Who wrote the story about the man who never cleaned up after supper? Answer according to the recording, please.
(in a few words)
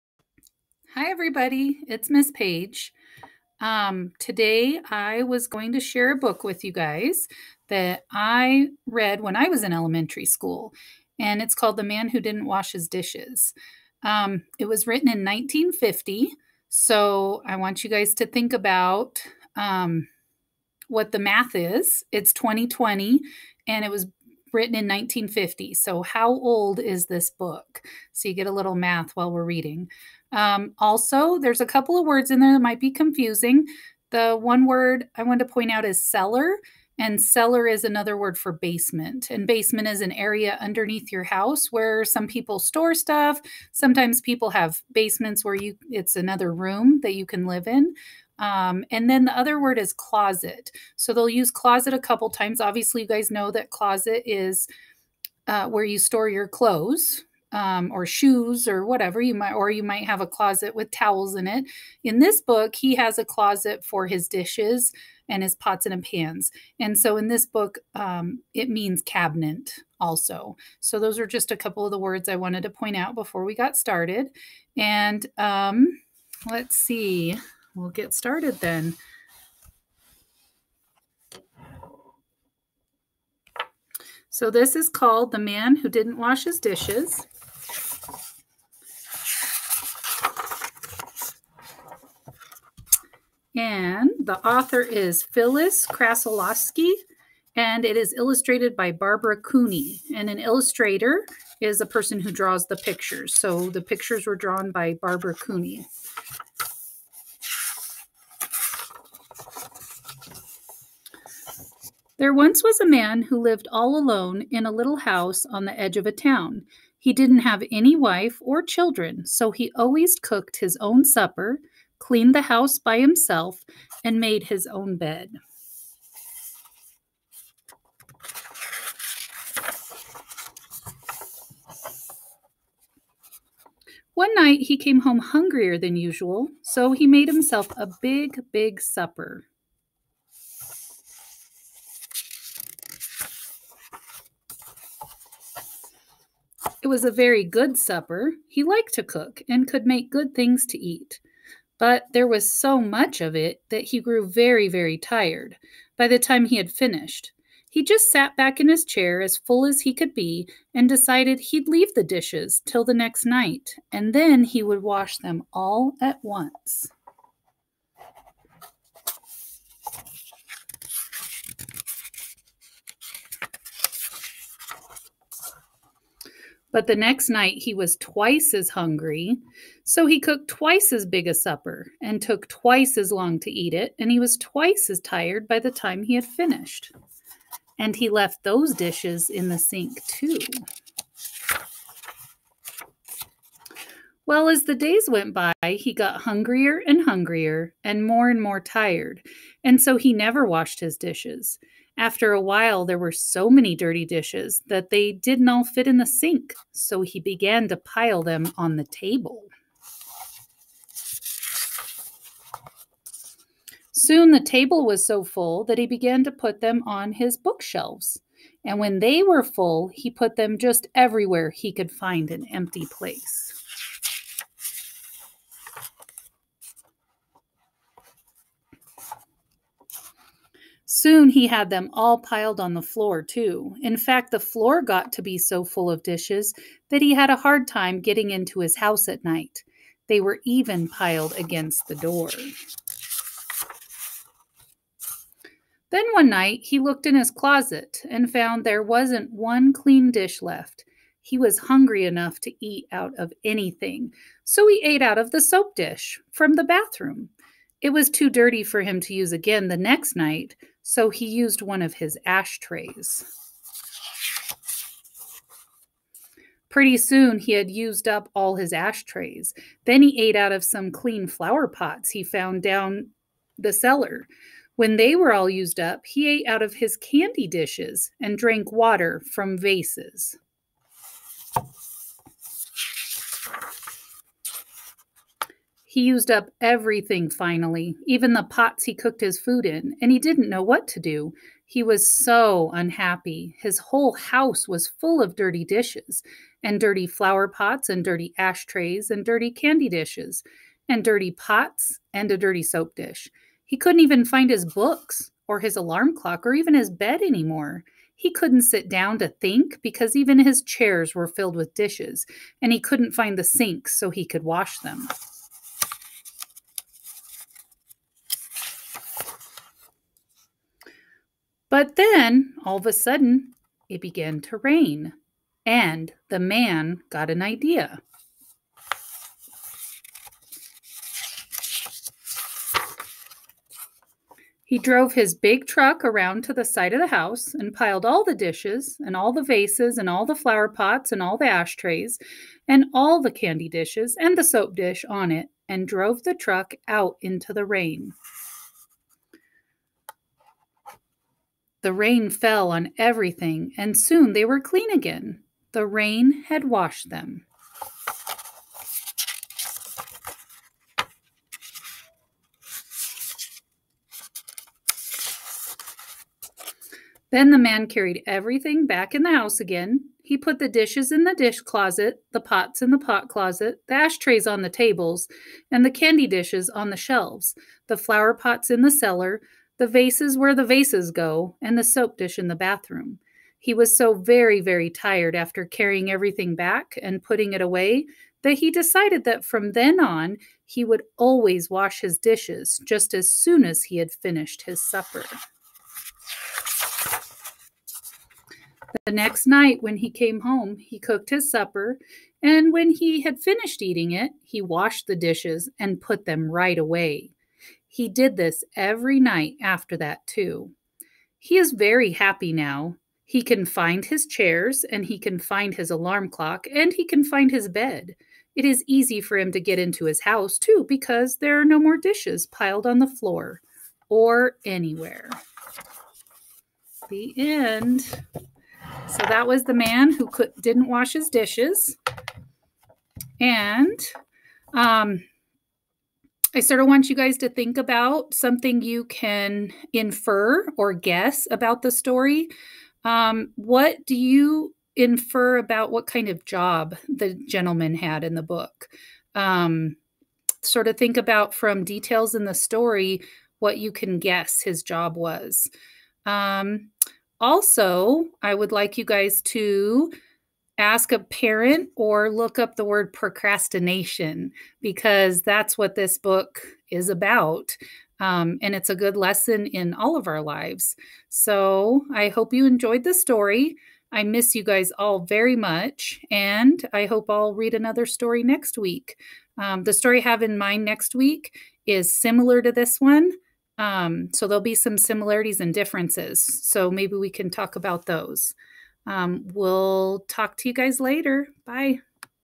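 Phyllis Krasilovsky.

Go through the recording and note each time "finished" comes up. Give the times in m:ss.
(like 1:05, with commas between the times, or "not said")
2:36, 3:06, 6:34, 6:43.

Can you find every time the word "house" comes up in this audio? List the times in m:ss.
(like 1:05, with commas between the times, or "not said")
0:41, 1:54, 2:02, 3:58, 4:54, 5:37, 6:09, 7:00.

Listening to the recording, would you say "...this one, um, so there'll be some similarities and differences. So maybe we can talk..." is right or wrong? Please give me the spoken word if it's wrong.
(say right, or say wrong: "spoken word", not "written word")
right.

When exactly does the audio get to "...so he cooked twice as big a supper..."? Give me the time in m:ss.
2:59.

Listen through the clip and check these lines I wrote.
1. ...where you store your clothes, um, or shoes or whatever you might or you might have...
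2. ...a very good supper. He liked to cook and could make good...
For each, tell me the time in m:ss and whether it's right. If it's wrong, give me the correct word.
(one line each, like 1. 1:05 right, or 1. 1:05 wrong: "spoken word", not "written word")
1. 0:55 right
2. 2:27 right.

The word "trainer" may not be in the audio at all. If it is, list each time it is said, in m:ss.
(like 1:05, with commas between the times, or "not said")
not said.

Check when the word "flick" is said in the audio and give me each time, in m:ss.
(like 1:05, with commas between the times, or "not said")
not said.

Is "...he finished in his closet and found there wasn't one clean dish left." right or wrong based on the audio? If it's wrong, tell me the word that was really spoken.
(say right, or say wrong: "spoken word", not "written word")
wrong: "looked", not "finished".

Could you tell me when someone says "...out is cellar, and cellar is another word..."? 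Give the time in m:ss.
0:35.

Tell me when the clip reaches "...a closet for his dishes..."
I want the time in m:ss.
1:03.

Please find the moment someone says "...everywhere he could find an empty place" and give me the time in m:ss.
3:40.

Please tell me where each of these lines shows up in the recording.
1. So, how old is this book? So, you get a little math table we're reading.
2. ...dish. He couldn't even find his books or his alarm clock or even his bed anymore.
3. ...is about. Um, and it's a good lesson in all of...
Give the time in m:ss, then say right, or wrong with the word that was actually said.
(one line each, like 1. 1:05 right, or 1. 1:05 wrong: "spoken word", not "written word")
1. 0:25 wrong: "while", not "table"
2. 5:02 right
3. 7:46 right.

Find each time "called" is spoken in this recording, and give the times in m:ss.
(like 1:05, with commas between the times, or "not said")
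0:11, 1:24.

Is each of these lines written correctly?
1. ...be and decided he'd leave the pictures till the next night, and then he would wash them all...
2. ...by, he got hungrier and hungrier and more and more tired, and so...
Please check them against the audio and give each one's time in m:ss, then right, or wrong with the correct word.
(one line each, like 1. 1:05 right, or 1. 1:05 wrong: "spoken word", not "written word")
1. 2:40 wrong: "dishes", not "pictures"
2. 3:15 right.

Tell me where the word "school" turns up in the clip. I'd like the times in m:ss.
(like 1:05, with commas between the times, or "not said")
0:10.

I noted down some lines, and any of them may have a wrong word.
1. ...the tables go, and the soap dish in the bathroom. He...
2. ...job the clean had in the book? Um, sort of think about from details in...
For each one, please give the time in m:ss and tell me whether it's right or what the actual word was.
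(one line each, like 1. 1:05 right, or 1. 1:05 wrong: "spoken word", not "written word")
1. 6:20 wrong: "vases", not "tables"
2. 7:26 wrong: "gentleman", not "clean".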